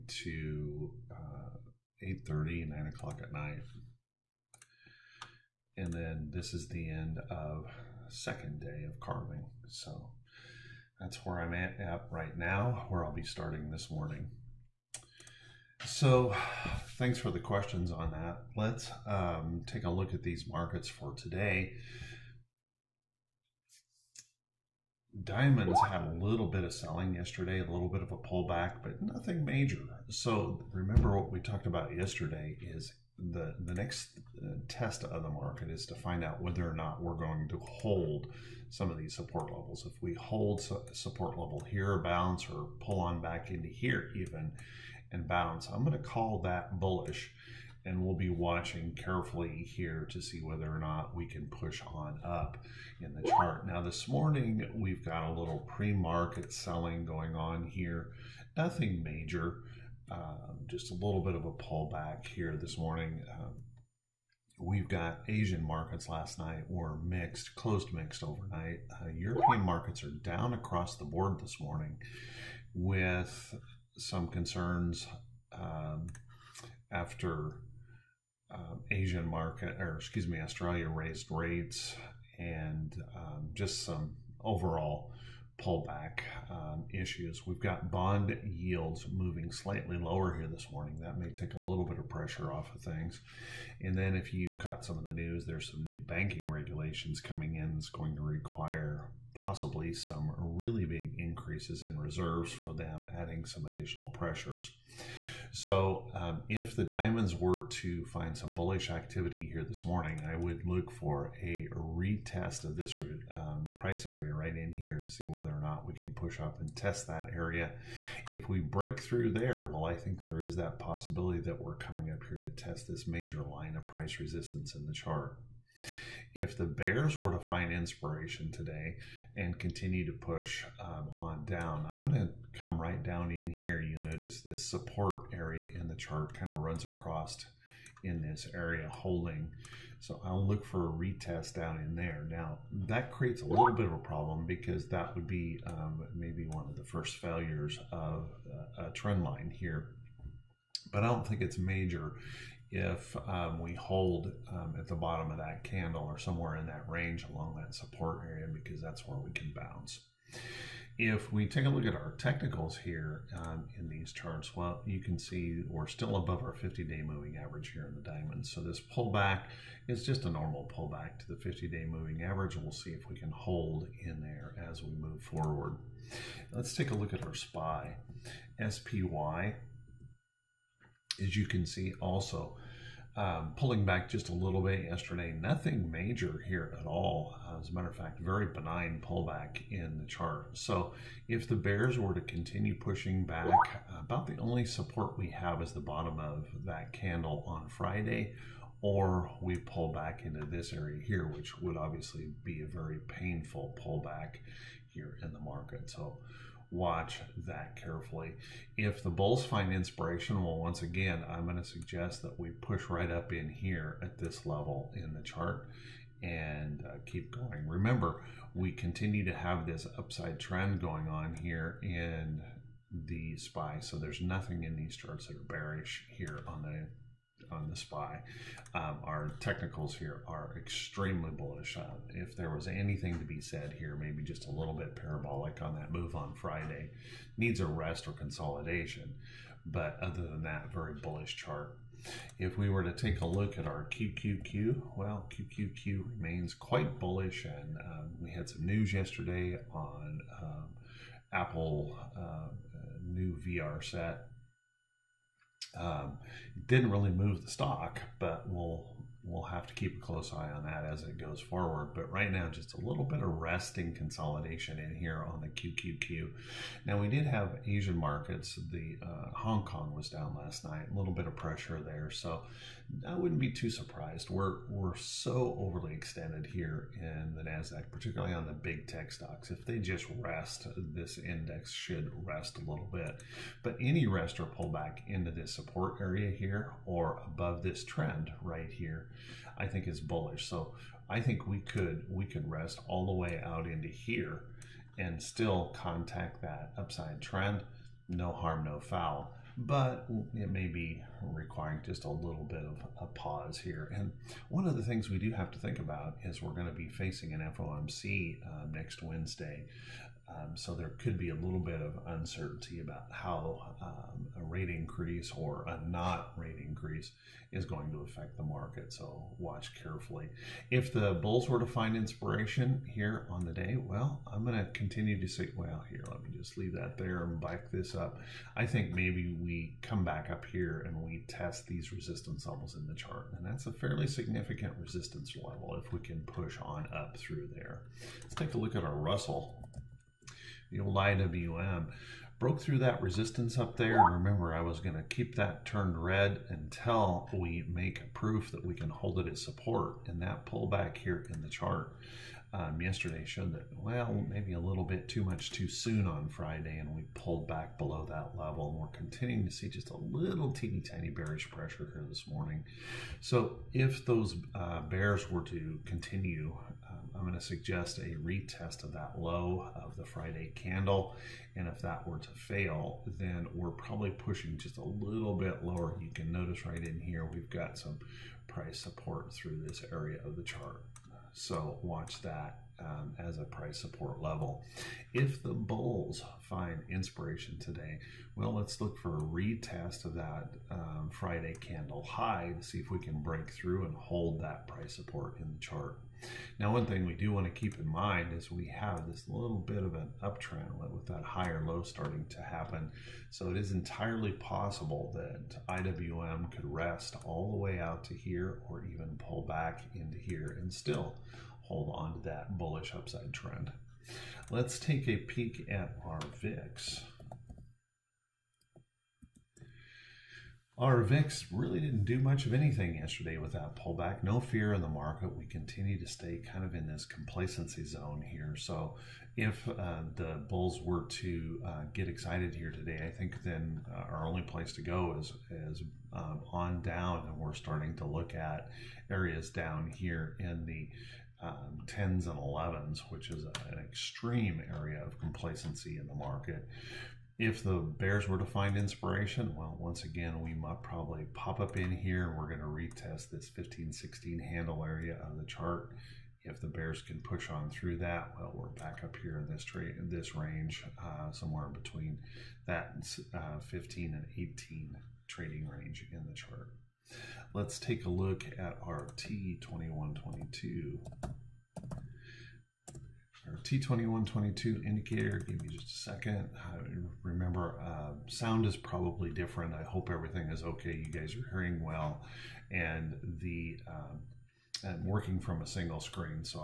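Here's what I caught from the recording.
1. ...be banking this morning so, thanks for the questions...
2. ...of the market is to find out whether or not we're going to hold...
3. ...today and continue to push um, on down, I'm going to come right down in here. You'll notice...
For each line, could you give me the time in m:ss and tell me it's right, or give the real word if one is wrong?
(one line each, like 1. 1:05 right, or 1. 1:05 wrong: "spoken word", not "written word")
1. 0:13 wrong: "starting", not "banking"
2. 0:35 right
3. 2:08 right.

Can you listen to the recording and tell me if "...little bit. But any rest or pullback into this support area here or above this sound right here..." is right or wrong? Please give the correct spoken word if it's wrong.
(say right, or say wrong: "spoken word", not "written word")
wrong: "trend", not "sound".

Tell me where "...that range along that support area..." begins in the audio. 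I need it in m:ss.
2:36.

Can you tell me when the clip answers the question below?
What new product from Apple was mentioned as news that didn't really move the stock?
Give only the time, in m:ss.
4:13.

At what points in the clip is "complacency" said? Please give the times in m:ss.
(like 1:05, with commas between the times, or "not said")
7:07, 7:25.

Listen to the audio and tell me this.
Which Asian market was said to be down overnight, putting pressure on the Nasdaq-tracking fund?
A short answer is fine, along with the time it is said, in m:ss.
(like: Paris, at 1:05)
Hong Kong, at 4:29.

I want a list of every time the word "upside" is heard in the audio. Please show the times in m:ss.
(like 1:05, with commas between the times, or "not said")
3:39, 4:56, 6:52.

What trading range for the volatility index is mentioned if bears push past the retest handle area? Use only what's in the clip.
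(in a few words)
15 to 18.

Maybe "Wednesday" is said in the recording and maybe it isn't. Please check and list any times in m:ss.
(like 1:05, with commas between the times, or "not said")
5:09.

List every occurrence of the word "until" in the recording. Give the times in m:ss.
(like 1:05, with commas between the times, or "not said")
5:46.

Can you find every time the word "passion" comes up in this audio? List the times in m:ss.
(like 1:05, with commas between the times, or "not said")
not said.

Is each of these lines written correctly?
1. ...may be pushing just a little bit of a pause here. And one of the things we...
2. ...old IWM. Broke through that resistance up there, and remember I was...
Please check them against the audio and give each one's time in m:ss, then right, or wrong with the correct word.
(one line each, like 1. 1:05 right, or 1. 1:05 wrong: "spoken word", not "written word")
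1. 5:00 wrong: "requiring", not "pushing"
2. 5:40 right.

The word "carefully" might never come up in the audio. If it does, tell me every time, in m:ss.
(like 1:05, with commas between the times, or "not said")
0:48, 3:27, 5:19.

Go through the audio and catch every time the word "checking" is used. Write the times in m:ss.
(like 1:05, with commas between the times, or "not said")
not said.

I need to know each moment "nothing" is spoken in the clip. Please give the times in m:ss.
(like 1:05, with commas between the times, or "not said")
0:29, 0:58, 3:05, 3:44.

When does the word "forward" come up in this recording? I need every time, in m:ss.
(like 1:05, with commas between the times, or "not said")
2:55, 4:21.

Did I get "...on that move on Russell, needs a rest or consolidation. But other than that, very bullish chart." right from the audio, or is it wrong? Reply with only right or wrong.
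wrong.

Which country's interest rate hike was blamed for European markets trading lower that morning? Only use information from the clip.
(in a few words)
Australia.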